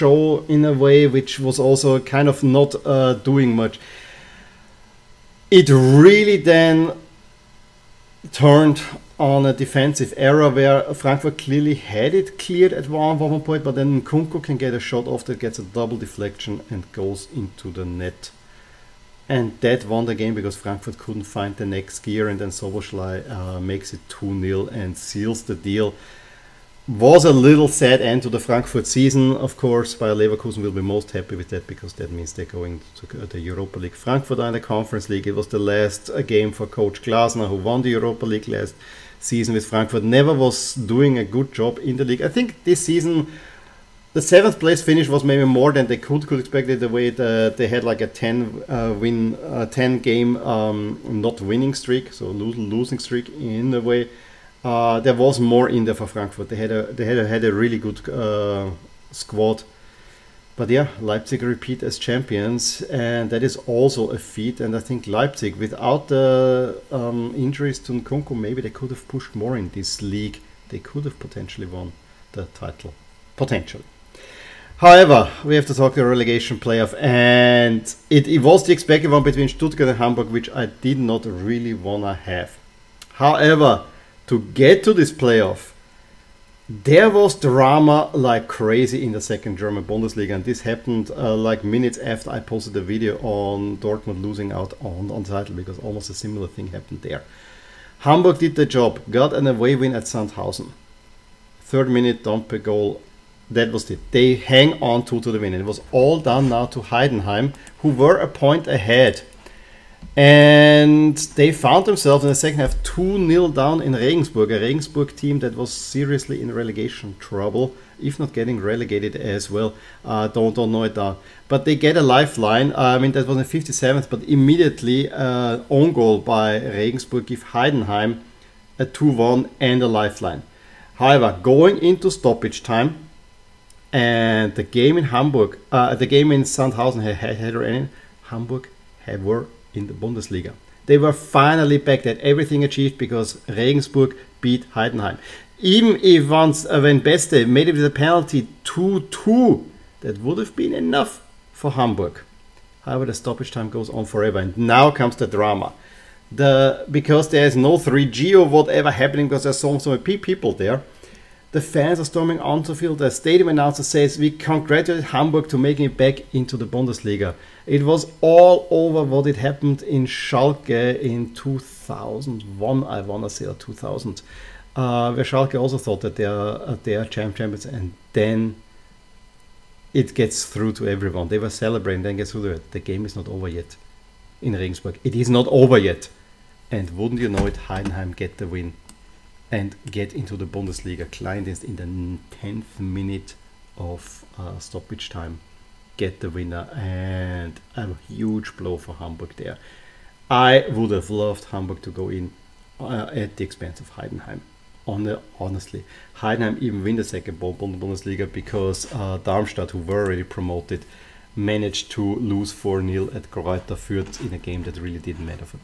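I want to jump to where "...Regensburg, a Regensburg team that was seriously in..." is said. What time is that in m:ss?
1:53.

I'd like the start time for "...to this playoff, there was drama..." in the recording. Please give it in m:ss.
1:24.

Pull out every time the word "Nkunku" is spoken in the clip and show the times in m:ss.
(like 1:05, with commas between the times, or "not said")
0:14, 1:07.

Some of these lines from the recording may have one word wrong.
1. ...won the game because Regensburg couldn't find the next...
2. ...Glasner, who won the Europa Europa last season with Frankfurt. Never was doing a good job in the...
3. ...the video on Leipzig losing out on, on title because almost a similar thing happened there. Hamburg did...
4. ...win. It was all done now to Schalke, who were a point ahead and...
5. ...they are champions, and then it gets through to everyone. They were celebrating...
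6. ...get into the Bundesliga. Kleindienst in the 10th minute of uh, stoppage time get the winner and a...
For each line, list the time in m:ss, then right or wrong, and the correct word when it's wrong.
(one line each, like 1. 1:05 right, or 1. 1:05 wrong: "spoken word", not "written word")
1. 0:19 wrong: "Frankfurt", not "Regensburg"
2. 0:37 wrong: "League", not "Europa"
3. 1:32 wrong: "Dortmund", not "Leipzig"
4. 1:45 wrong: "Heidenheim", not "Schalke"
5. 2:56 right
6. 3:09 right.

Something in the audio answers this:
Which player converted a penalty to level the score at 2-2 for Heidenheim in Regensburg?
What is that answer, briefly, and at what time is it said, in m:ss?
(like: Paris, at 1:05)
Beste, at 2:27.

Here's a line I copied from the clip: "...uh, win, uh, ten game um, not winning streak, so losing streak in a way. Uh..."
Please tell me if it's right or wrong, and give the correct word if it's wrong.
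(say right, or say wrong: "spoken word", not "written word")
right.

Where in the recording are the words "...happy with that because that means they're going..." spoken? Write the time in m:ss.
0:31.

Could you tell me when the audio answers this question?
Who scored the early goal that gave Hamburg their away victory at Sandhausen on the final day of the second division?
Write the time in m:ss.
1:42.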